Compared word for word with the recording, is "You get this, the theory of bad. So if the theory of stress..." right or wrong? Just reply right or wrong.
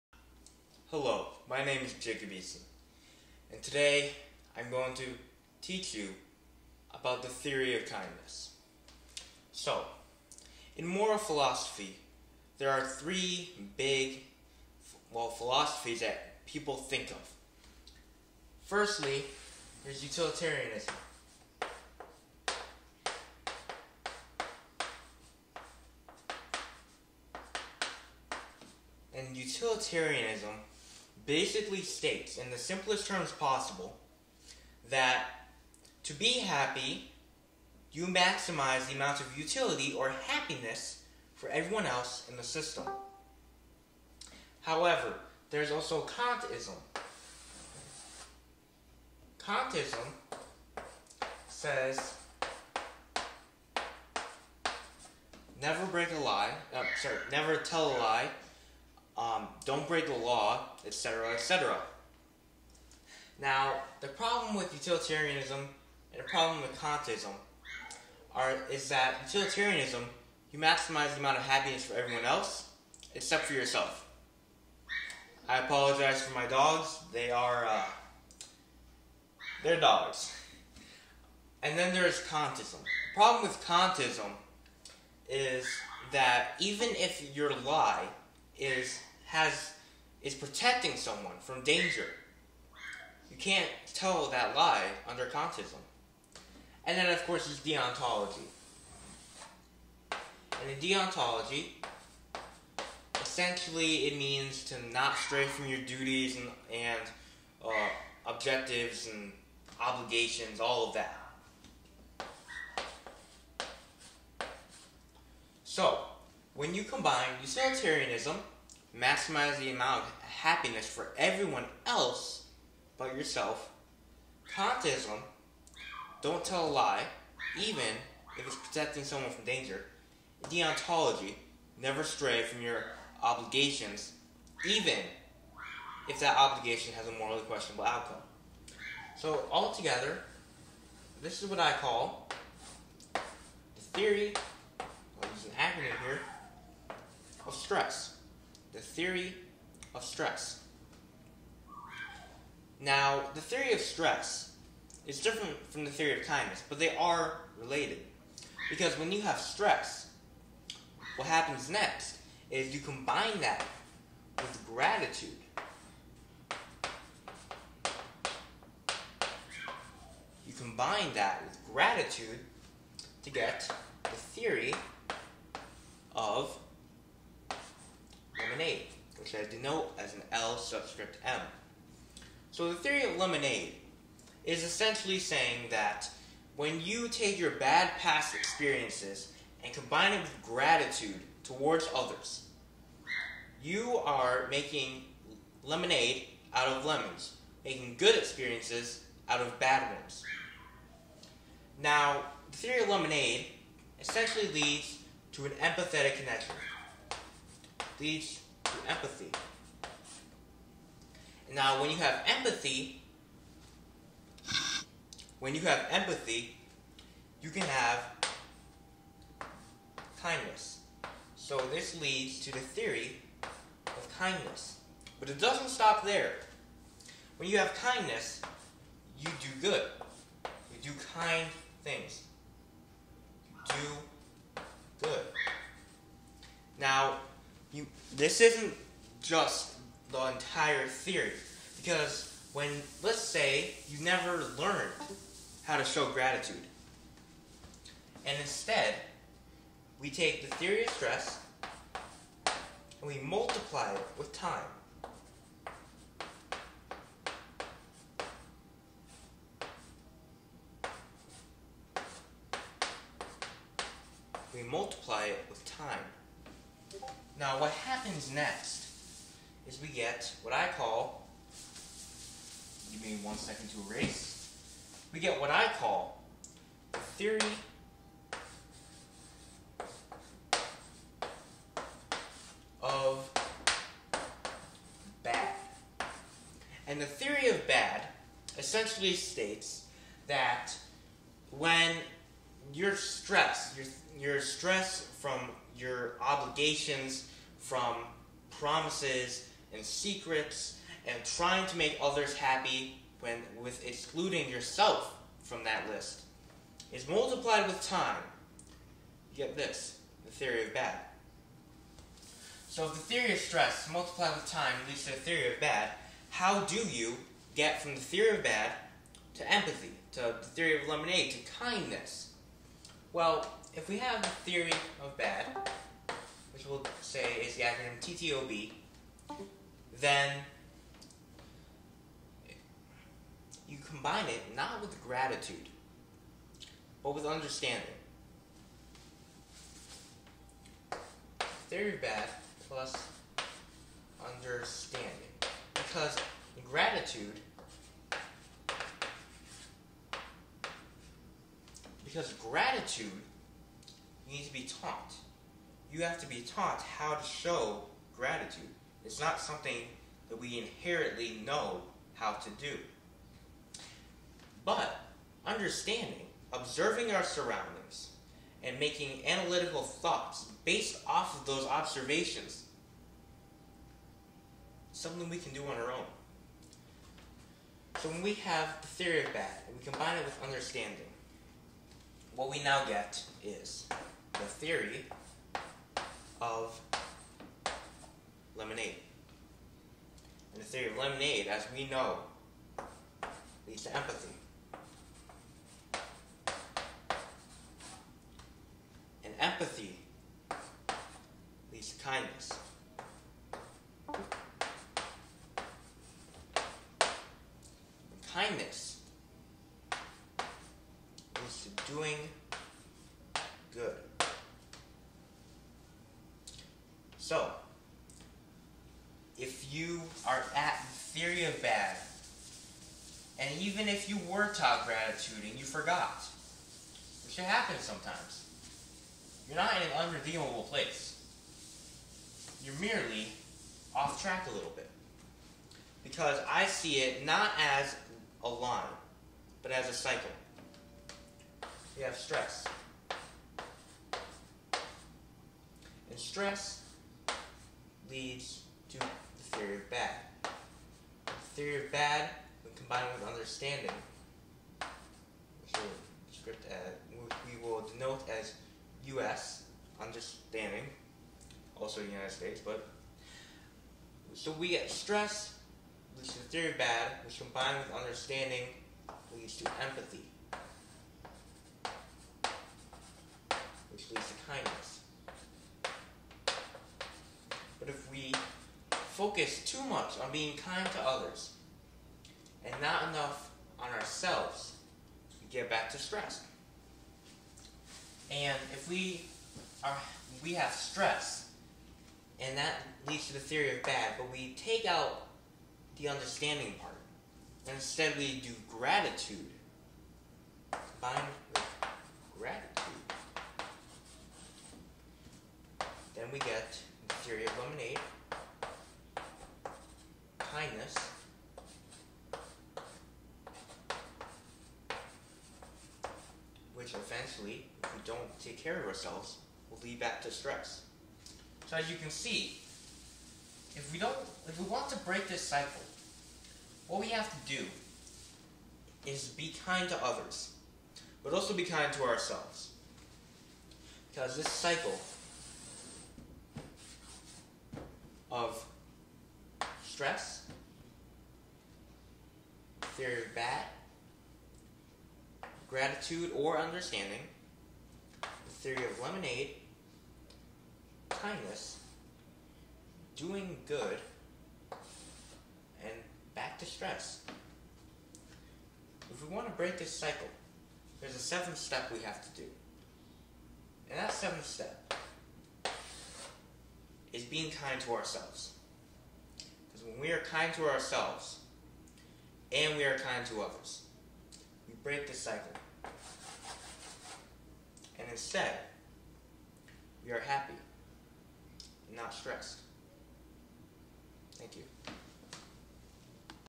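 right.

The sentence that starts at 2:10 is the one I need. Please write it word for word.
Deontology, never stray from your obligations, even if that obligation has a morally questionable outcome.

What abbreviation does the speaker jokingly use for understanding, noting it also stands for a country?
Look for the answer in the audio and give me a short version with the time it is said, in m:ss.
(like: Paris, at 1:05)
U.S., at 7:39.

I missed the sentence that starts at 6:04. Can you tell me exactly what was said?
But understanding, observing our surroundings, and making analytical thoughts based off of those observations, something we can do on our own.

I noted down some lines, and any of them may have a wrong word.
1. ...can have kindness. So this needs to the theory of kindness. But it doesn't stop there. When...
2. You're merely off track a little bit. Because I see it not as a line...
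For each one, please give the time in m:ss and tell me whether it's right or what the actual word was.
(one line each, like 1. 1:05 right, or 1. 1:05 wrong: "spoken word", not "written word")
1. 3:37 wrong: "leads", not "needs"
2. 7:12 right.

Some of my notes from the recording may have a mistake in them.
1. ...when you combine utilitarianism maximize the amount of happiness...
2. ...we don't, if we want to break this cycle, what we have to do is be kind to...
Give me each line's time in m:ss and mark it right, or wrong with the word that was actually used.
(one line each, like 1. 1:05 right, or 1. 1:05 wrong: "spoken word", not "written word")
1. 1:56 right
2. 8:43 right.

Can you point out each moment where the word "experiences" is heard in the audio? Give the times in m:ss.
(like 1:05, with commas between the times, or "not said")
3:08, 3:18.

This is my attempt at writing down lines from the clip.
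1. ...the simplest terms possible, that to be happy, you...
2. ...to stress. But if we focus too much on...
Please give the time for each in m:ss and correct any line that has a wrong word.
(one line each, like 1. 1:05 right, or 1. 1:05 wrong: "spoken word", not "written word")
1. 0:32 right
2. 7:54 wrong: "kindness", not "stress".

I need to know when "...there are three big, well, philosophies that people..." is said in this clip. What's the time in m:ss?
0:12.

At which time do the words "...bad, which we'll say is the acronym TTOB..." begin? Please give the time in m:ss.
5:25.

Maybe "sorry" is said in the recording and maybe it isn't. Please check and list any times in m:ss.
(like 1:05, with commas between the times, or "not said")
0:57.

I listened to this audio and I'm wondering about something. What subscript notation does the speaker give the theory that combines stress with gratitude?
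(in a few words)
L subscript M.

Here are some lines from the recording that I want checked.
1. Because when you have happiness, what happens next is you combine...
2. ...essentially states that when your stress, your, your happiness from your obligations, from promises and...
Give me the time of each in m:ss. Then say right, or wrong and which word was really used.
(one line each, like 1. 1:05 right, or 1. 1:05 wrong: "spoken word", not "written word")
1. 2:38 wrong: "stress", not "happiness"
2. 4:48 wrong: "stress", not "happiness".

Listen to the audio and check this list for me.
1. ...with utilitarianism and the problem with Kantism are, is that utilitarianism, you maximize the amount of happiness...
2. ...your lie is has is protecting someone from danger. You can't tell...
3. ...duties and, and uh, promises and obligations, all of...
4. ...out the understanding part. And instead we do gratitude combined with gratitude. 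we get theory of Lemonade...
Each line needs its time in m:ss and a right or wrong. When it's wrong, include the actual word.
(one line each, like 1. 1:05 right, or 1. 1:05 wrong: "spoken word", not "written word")
1. 1:04 right
2. 1:27 right
3. 1:45 wrong: "objectives", not "promises"
4. 8:14 right.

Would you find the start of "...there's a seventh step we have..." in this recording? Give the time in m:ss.
9:21.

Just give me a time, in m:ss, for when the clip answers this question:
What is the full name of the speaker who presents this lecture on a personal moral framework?
0:01.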